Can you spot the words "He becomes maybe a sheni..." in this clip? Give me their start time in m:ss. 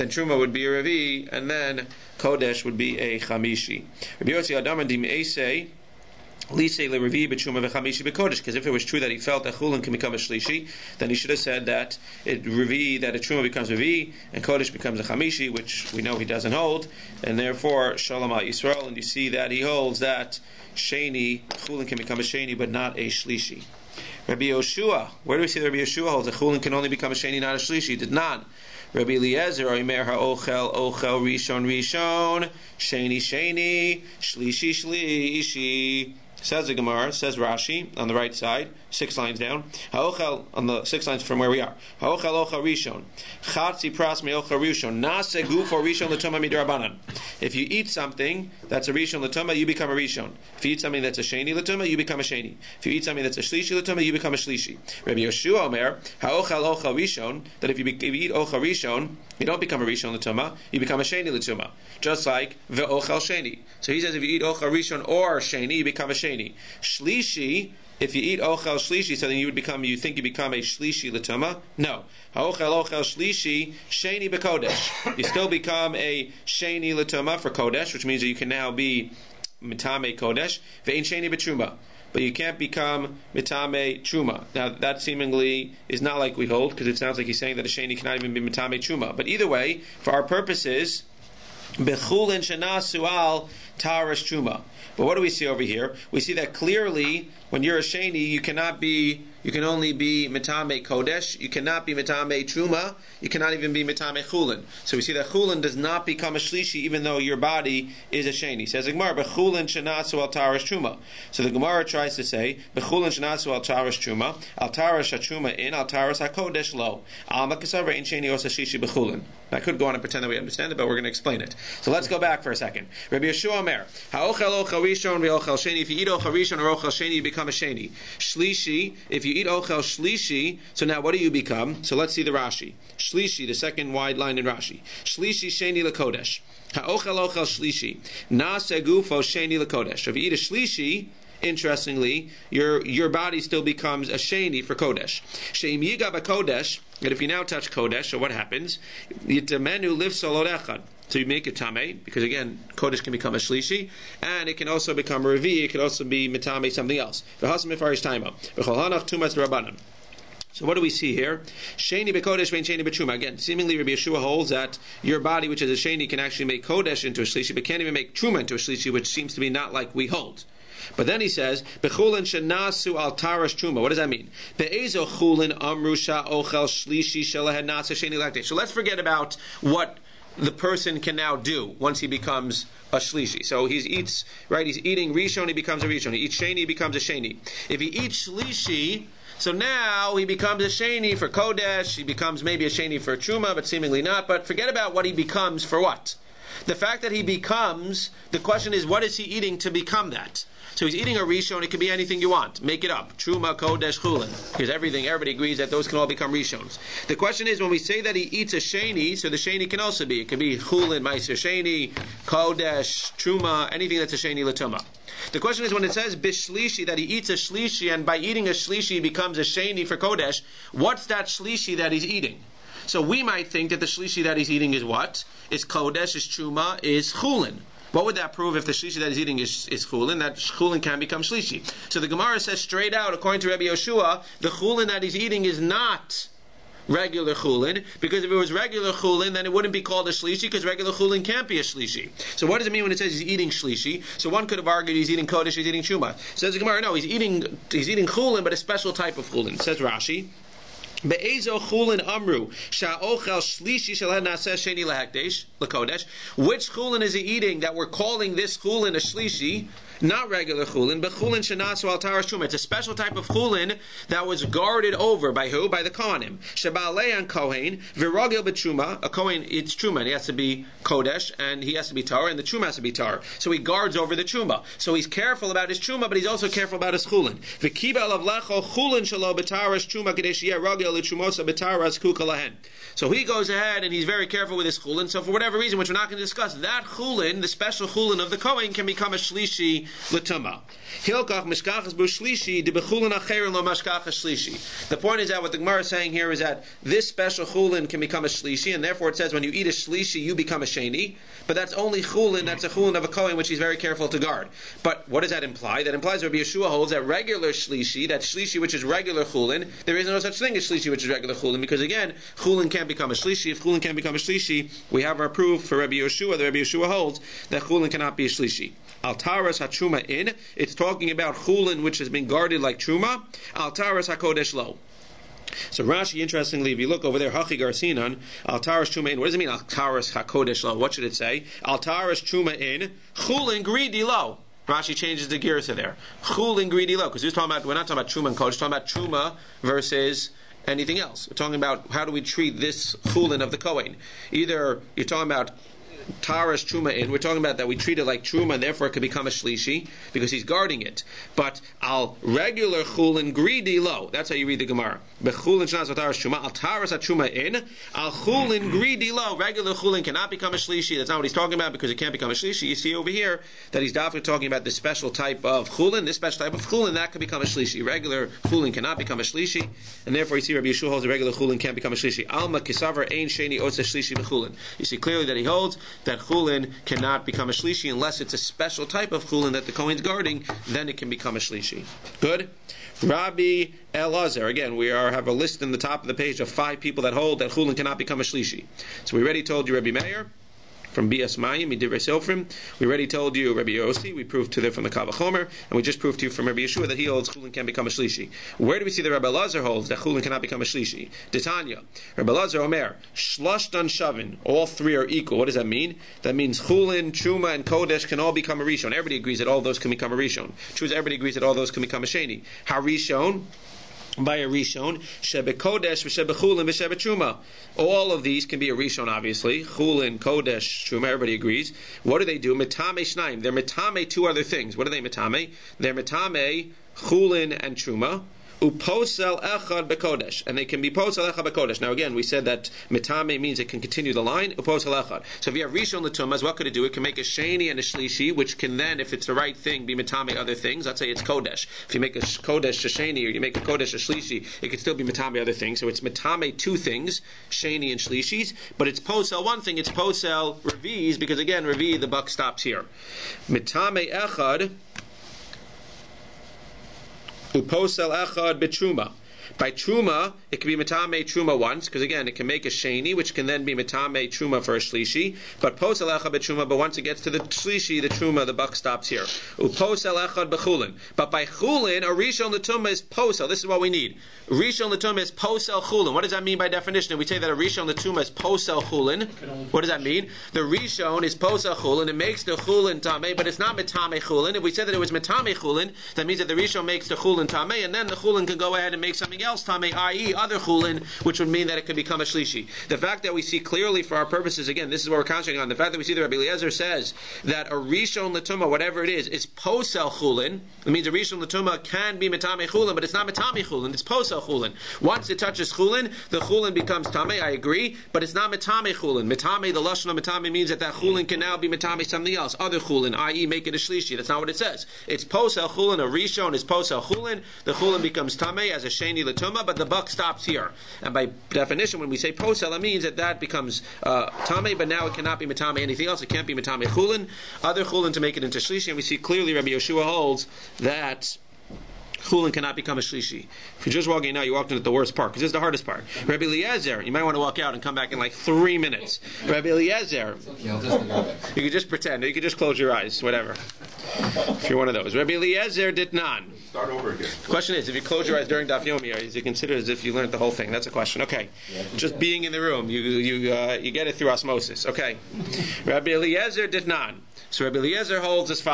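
3:11.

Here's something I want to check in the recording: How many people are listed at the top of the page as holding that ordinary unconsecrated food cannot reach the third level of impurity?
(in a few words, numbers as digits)
5.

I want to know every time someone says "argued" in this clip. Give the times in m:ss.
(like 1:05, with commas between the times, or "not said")
4:04.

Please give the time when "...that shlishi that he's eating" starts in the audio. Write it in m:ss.
3:41.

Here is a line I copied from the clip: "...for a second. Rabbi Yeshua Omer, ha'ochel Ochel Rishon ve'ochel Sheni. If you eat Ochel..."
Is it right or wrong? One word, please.
right.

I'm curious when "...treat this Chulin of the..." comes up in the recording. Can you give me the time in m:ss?
5:42.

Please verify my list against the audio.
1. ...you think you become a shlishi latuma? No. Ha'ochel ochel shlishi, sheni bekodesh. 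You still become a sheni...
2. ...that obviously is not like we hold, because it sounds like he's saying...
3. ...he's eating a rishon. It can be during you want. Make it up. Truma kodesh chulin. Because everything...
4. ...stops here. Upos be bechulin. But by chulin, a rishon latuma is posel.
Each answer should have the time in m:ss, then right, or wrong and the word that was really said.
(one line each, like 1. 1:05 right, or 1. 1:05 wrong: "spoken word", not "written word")
1. 1:09 right
2. 1:24 wrong: "seemingly", not "obviously"
3. 3:20 wrong: "anything", not "during"
4. 7:48 right.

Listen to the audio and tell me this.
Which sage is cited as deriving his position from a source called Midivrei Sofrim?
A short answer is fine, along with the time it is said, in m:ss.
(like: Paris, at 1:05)
Rabbi Meir, at 6:29.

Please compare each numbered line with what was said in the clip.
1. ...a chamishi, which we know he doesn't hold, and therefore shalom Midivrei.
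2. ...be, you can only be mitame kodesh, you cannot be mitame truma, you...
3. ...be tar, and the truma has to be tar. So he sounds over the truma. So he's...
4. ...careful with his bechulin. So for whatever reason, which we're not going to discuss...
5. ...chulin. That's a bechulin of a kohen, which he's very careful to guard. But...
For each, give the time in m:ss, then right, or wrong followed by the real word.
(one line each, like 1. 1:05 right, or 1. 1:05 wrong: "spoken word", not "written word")
1. 0:14 wrong: "Yisrael", not "Midivrei"
2. 1:38 right
3. 4:31 wrong: "guards", not "sounds"
4. 4:44 wrong: "chulin", not "bechulin"
5. 5:02 wrong: "chulin", not "bechulin".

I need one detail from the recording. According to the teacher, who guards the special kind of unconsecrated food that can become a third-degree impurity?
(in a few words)
The kohanim.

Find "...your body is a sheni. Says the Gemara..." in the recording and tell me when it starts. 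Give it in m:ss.
1:47.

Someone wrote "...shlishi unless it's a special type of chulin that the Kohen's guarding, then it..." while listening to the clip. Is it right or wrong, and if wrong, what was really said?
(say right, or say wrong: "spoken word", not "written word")
right.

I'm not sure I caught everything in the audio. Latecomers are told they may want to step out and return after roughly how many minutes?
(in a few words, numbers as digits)
3.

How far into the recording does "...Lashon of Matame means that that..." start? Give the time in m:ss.
8:29.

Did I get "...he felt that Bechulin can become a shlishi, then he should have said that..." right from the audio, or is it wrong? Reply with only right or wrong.
wrong.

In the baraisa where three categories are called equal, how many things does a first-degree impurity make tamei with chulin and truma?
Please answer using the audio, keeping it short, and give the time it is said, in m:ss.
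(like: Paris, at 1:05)
2, at 7:03.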